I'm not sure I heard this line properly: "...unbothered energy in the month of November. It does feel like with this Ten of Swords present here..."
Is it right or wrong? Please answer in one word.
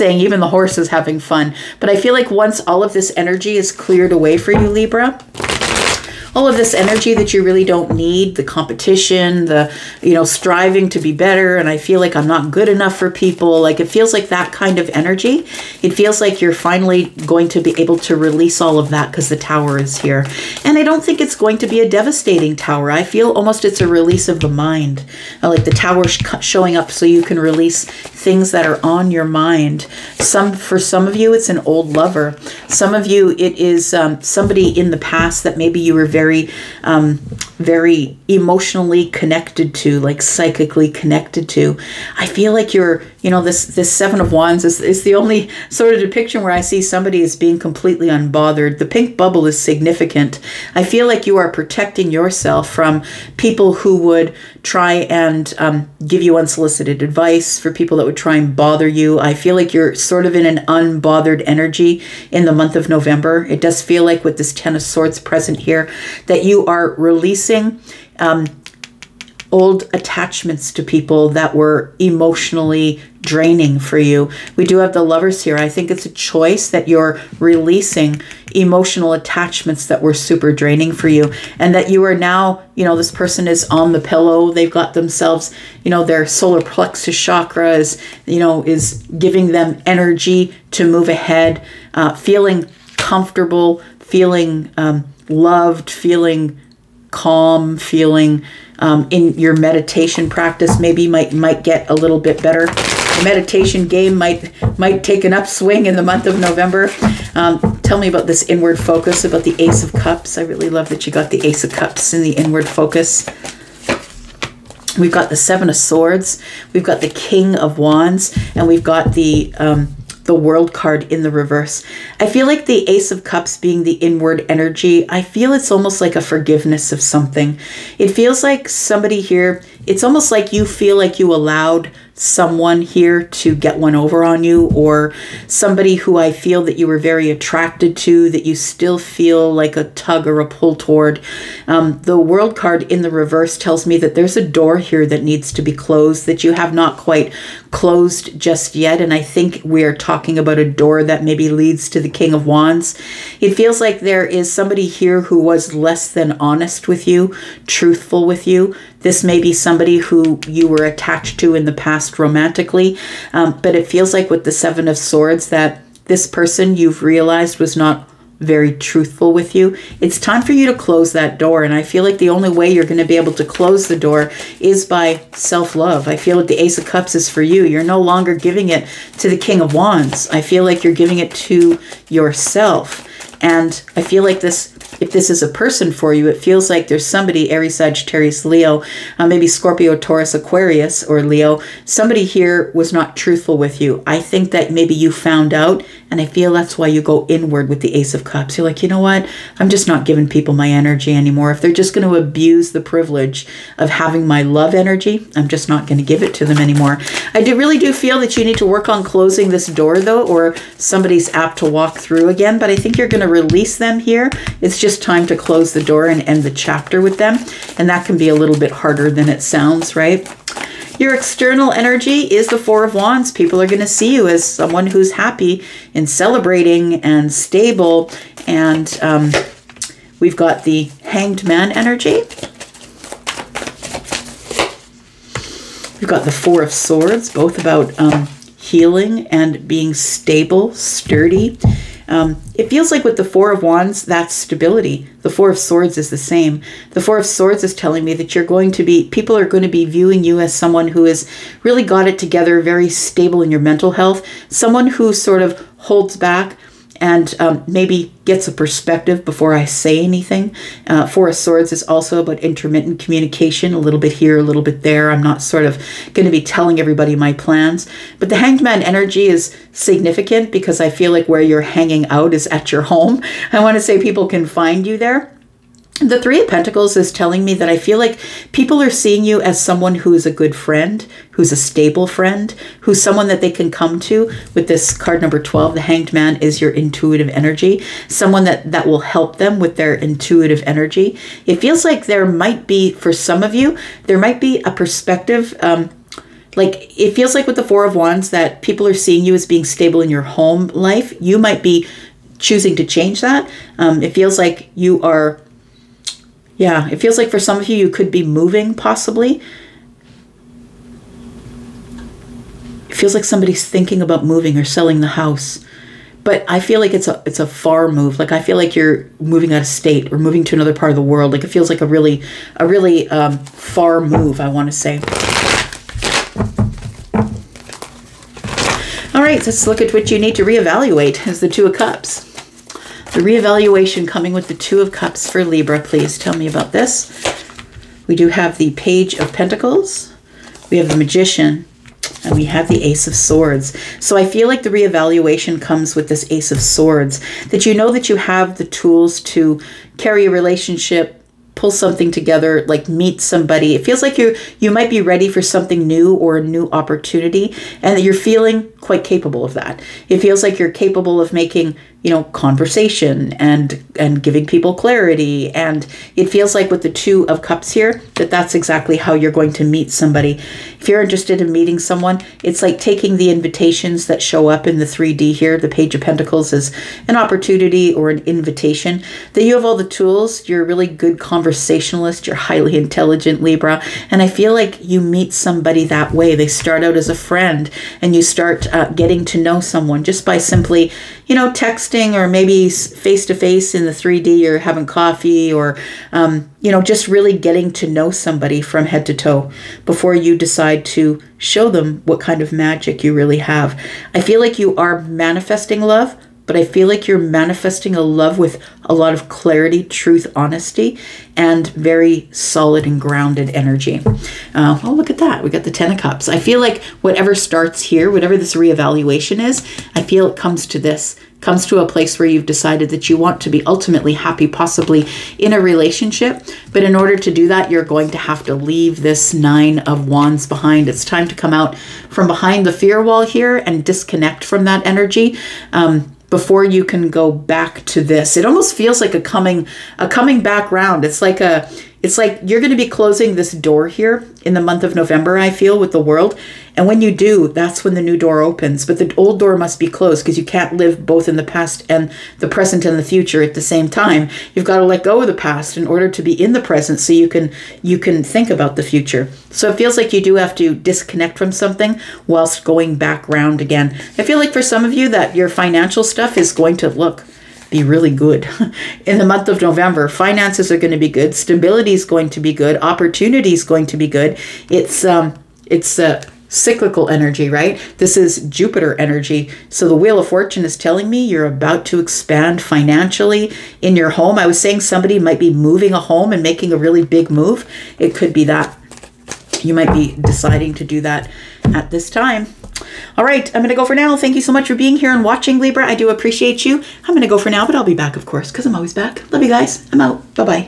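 right.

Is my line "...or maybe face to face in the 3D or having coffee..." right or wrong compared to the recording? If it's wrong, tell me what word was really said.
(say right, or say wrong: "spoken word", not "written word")
right.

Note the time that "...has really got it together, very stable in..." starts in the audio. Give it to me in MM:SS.
04:11.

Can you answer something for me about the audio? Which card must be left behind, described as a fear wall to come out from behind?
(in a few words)
Nine of Wands.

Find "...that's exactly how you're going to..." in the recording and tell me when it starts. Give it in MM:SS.
06:08.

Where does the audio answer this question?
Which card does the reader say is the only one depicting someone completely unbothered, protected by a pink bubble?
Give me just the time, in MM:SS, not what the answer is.
00:43.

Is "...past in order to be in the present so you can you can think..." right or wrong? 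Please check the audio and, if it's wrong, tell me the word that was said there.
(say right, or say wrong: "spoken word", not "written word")
right.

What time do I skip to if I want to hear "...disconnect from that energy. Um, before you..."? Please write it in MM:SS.
07:13.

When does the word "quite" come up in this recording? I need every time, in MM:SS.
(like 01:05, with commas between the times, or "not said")
02:26, 05:58.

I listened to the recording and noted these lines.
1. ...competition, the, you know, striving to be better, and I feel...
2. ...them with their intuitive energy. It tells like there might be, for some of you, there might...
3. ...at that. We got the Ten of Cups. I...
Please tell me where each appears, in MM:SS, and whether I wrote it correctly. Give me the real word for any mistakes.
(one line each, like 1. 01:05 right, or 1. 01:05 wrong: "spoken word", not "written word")
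1. 00:08 right
2. 04:49 wrong: "feels", not "tells"
3. 06:55 right.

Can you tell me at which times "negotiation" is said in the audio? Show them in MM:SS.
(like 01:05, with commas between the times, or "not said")
not said.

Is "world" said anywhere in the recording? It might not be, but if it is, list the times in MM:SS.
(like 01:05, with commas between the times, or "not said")
02:00, 02:22, 05:21, 07:26.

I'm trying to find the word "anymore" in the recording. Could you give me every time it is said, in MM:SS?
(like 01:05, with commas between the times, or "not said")
03:21, 03:26.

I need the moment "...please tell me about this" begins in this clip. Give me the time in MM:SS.
05:35.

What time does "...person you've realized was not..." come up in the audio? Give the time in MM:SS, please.
02:46.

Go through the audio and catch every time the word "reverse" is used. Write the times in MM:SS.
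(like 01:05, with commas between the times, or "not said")
02:01, 02:23.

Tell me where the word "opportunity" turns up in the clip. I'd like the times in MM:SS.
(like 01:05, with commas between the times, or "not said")
05:56, 06:17, 07:52.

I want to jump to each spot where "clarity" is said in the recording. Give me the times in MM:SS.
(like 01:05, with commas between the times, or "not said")
06:04, 06:49.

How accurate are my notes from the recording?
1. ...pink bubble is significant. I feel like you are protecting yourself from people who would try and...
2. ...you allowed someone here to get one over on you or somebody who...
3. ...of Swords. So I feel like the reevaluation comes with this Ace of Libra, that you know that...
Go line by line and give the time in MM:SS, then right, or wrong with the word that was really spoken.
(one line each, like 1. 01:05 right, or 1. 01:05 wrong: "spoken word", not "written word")
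1. 00:48 right
2. 02:11 right
3. 05:43 wrong: "Swords", not "Libra".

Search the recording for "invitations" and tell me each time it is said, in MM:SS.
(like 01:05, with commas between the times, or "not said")
06:13, 06:18.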